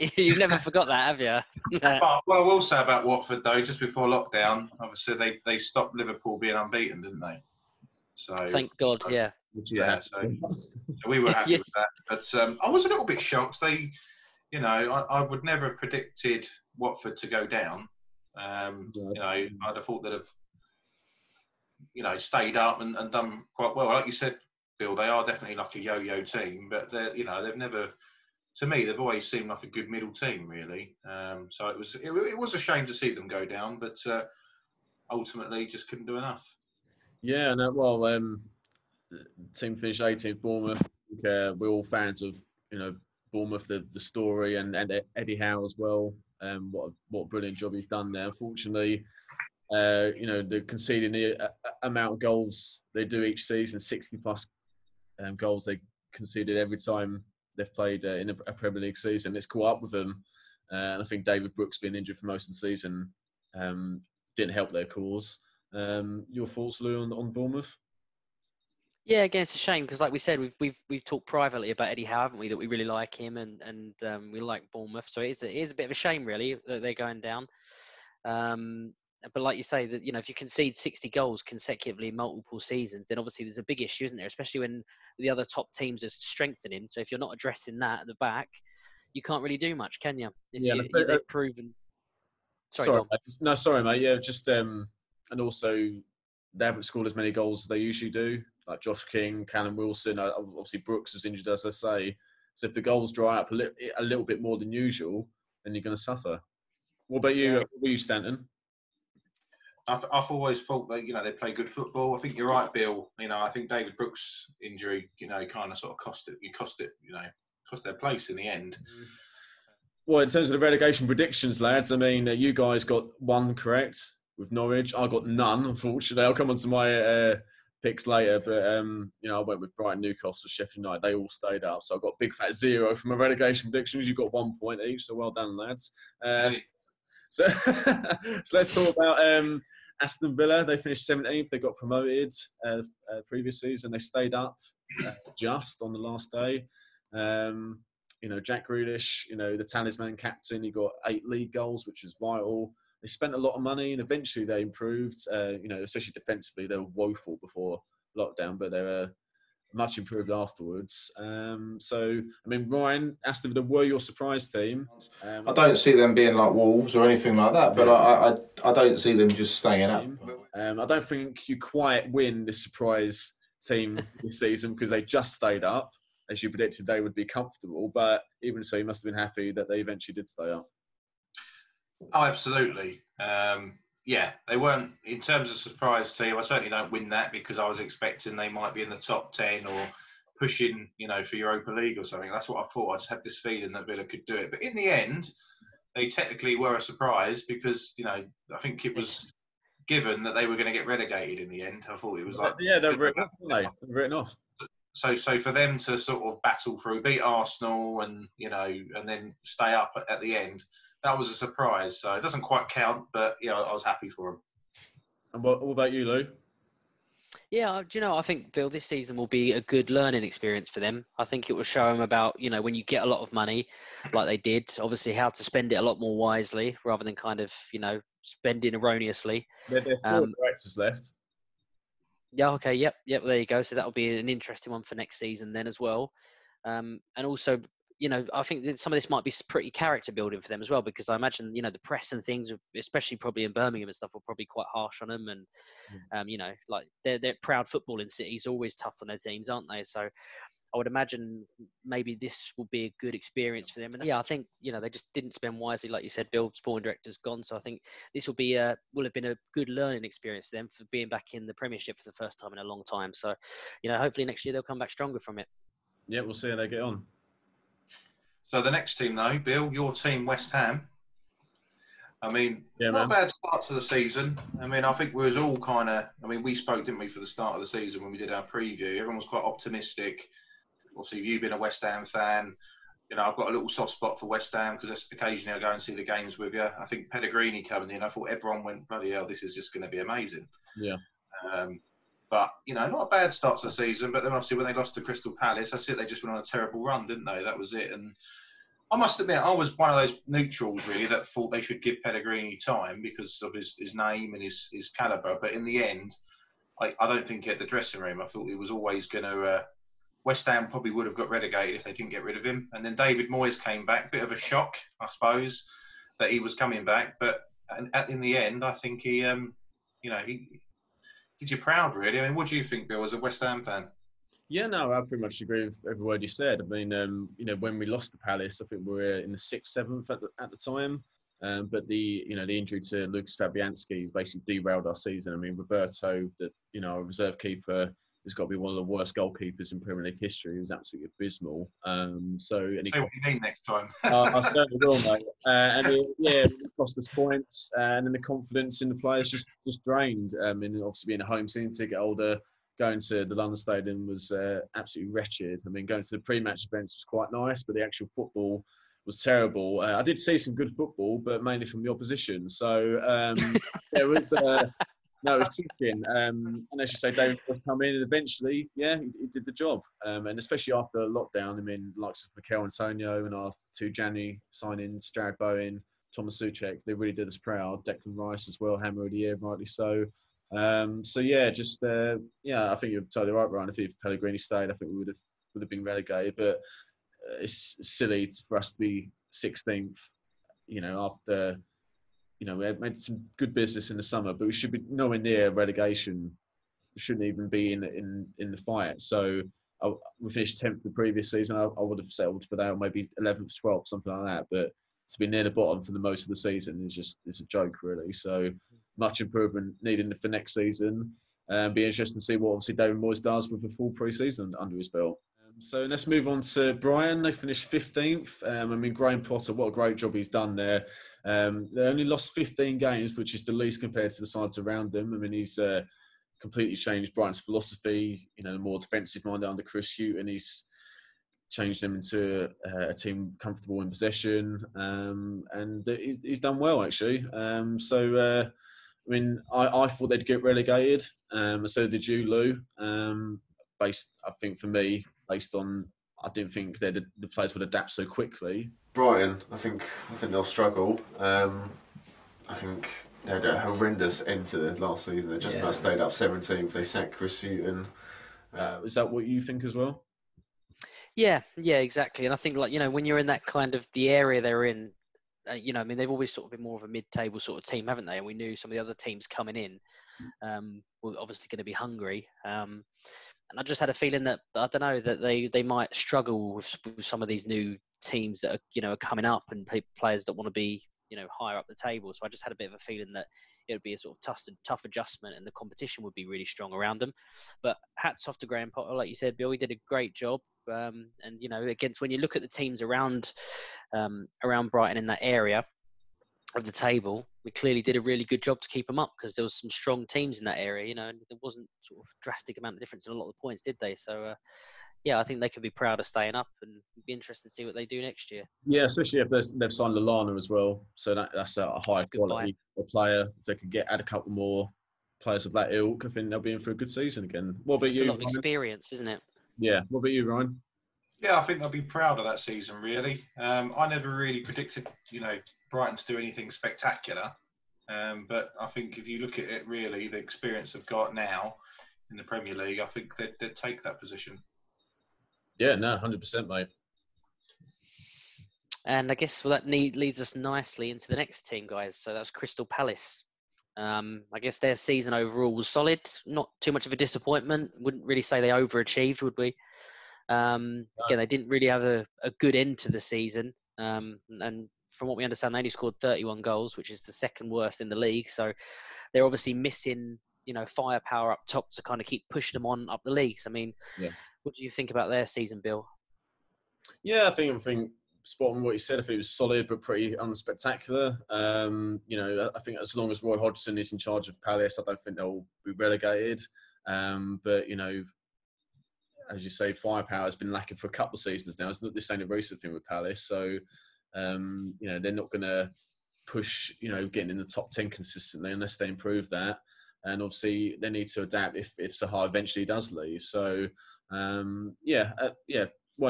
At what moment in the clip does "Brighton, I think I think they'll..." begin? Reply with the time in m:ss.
7:28.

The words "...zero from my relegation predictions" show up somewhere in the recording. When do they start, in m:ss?
2:12.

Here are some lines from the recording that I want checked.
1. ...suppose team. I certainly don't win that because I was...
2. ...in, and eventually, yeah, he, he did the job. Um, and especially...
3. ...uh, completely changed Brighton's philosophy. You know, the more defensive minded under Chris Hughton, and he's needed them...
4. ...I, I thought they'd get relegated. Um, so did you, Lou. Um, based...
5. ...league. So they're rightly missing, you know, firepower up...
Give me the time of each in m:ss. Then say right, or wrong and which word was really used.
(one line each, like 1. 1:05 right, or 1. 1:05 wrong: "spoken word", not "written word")
1. 3:05 wrong: "surprise", not "suppose"
2. 6:07 right
3. 7:05 wrong: "changed", not "needed"
4. 7:19 right
5. 9:17 wrong: "obviously", not "rightly".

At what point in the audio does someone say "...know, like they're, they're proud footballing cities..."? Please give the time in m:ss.
4:06.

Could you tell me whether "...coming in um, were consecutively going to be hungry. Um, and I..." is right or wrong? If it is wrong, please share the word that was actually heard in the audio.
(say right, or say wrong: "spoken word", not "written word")
wrong: "obviously", not "consecutively".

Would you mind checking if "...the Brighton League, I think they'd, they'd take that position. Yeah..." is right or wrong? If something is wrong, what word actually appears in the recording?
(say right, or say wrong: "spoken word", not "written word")
wrong: "Premier", not "Brighton".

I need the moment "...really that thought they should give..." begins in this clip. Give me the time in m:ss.
5:00.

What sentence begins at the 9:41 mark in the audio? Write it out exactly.
It's not this ain't a recent thing with Palace, so um, you know they're not going to push.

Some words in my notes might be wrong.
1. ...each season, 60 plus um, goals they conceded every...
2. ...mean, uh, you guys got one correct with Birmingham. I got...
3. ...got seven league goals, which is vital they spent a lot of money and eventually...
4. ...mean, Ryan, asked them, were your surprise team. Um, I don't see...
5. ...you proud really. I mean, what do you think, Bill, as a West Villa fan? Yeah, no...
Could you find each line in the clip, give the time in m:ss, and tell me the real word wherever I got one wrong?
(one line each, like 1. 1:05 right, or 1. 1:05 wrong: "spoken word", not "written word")
1. 0:53 right
2. 2:01 wrong: "Norwich", not "Birmingham"
3. 2:30 wrong: "eight", not "seven"
4. 2:42 right
5. 5:21 wrong: "Ham", not "Villa".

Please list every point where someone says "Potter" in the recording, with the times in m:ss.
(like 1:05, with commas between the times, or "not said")
6:59, 8:08.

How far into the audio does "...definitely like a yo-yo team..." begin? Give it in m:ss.
0:25.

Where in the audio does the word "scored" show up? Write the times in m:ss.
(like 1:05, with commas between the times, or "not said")
1:36, 9:15.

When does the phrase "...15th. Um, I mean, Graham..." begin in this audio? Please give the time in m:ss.
6:57.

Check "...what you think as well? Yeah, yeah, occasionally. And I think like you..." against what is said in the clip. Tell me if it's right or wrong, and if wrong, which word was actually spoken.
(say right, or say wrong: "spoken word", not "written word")
wrong: "exactly", not "occasionally".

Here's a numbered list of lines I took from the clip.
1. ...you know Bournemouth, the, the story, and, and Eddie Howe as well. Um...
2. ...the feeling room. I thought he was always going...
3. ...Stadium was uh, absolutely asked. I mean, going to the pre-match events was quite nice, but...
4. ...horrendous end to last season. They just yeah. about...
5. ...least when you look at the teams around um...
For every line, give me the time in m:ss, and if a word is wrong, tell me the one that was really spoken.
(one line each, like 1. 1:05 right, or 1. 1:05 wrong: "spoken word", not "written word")
1. 0:42 right
2. 5:07 wrong: "dressing", not "feeling"
3. 5:53 wrong: "wretched", not "asked"
4. 7:33 right
5. 8:11 wrong: "against", not "least".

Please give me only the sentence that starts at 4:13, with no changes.
And yeah, I think, you know, they just didn't spend wisely.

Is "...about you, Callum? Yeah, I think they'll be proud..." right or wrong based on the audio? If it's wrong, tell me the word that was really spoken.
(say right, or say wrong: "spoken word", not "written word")
wrong: "Ryan", not "Callum".